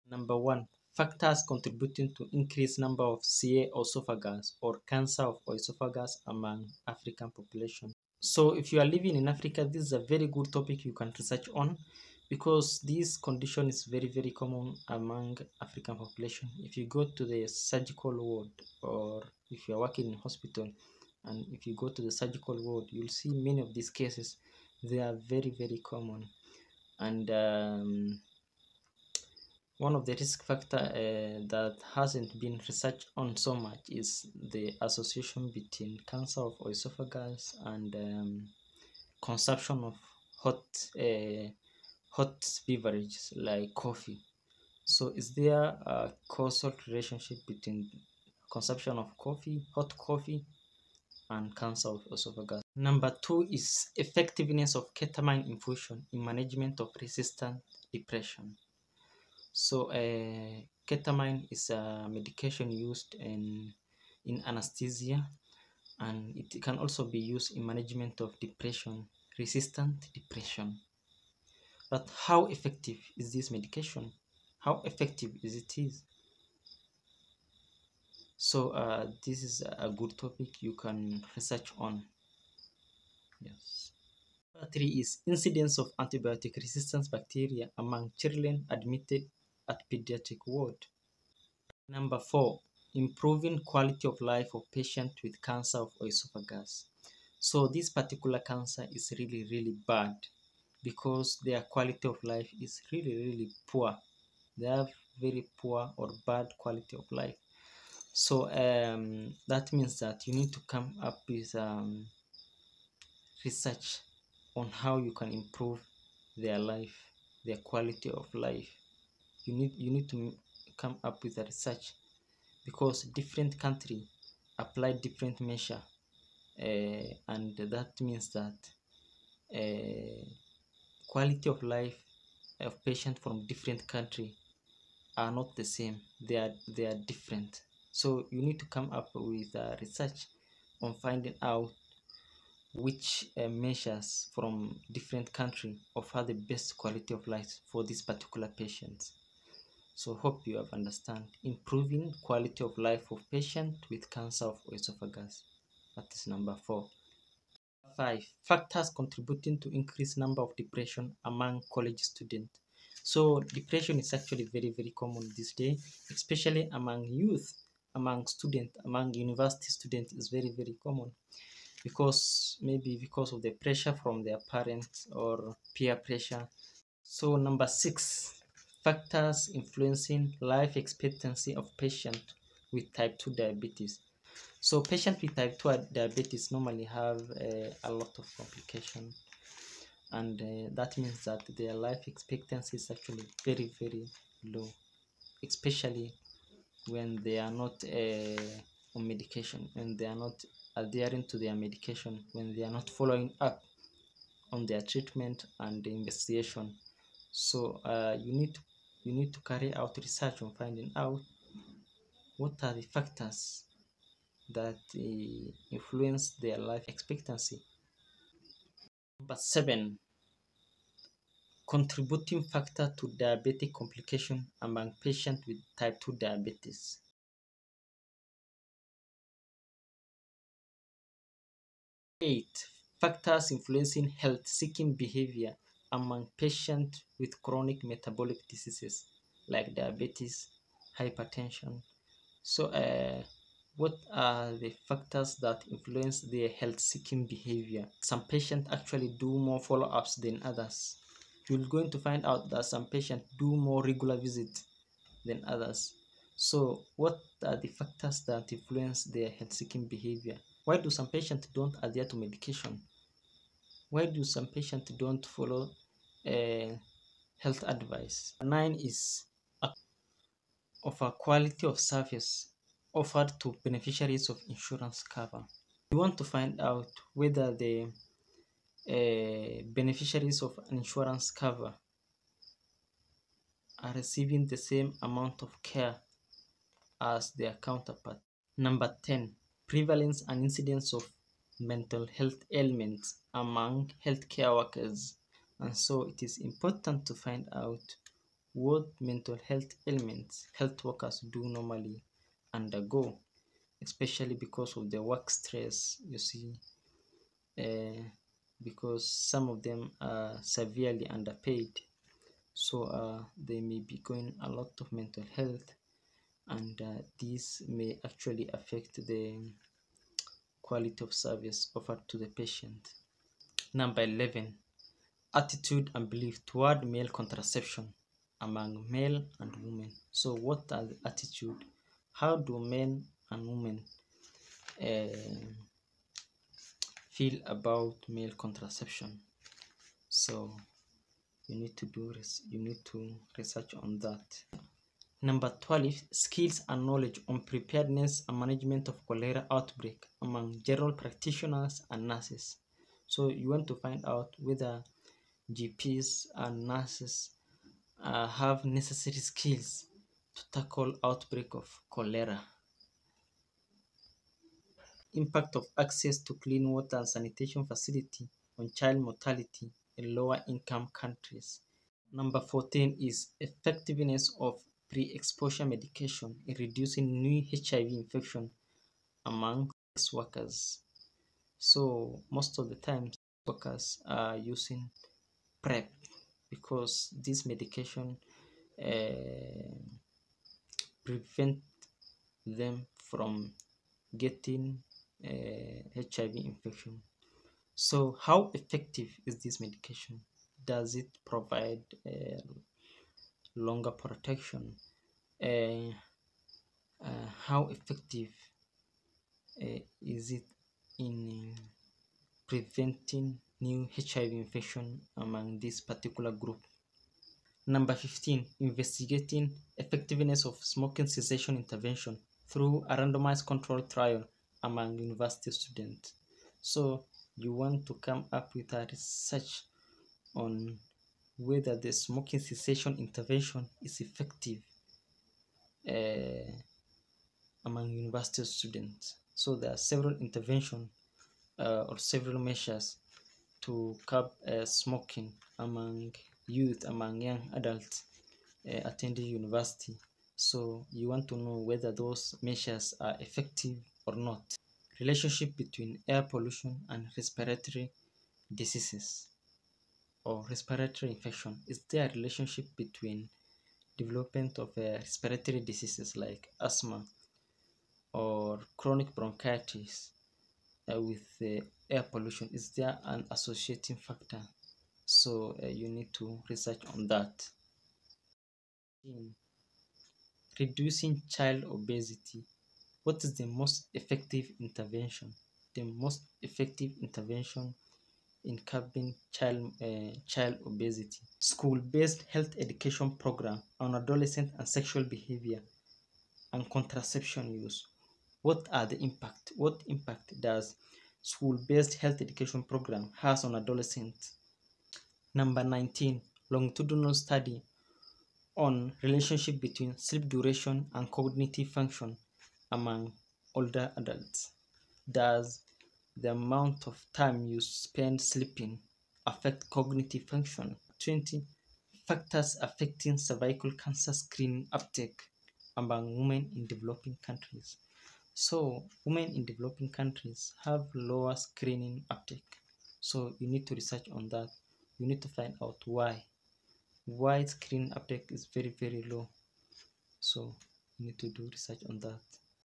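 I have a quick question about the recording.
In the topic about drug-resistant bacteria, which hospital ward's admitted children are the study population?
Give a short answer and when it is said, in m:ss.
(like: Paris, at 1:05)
Pediatric ward, at 1:29.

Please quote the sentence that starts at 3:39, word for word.
Number seven, contributing factor to diabetic complication among patients with type 2 diabetes.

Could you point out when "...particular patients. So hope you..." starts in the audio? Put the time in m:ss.
2:28.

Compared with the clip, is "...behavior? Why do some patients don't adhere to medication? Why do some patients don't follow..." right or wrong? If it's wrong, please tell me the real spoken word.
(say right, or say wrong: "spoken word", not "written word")
right.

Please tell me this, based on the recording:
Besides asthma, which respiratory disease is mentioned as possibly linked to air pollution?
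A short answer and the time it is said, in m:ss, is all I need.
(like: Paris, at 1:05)
Chronic bronchitis, at 7:48.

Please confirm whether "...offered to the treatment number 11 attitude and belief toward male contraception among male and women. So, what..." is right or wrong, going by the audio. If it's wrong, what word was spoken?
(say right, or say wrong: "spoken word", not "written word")
wrong: "patient", not "treatment".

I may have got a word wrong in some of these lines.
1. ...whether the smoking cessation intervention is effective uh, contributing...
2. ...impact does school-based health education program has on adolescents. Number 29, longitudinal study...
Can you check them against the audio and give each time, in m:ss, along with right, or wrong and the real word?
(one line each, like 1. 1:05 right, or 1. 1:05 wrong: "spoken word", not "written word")
1. 7:11 wrong: "among", not "contributing"
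2. 8:19 wrong: "19", not "29".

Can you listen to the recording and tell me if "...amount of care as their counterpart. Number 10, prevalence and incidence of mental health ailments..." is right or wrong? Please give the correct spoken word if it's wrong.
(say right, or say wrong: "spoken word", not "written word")
right.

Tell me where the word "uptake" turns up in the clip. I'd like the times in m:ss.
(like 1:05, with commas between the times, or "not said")
8:44, 8:52, 8:57.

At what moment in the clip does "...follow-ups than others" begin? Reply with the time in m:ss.
4:09.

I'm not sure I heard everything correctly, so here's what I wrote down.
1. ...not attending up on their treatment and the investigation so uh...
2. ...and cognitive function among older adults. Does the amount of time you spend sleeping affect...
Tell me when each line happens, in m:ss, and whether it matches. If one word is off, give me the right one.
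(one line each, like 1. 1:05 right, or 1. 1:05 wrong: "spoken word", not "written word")
1. 3:22 wrong: "following", not "attending"
2. 8:30 right.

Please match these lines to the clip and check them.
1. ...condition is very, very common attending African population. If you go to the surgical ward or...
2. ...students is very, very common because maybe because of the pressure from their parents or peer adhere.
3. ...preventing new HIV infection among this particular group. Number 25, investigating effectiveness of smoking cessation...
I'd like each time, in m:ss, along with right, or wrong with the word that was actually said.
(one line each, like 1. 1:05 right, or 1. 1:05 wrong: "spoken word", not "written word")
1. 0:13 wrong: "among", not "attending"
2. 2:49 wrong: "pressure", not "adhere"
3. 6:52 wrong: "15", not "25".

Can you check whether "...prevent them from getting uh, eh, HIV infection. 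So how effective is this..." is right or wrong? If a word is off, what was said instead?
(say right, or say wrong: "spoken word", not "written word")
right.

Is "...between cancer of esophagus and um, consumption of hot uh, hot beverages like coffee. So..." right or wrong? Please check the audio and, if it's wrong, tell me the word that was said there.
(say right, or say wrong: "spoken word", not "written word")
right.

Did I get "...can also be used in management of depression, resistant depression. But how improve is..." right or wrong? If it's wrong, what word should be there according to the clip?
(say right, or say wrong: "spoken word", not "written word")
wrong: "effective", not "improve".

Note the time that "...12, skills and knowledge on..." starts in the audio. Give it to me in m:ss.
5:45.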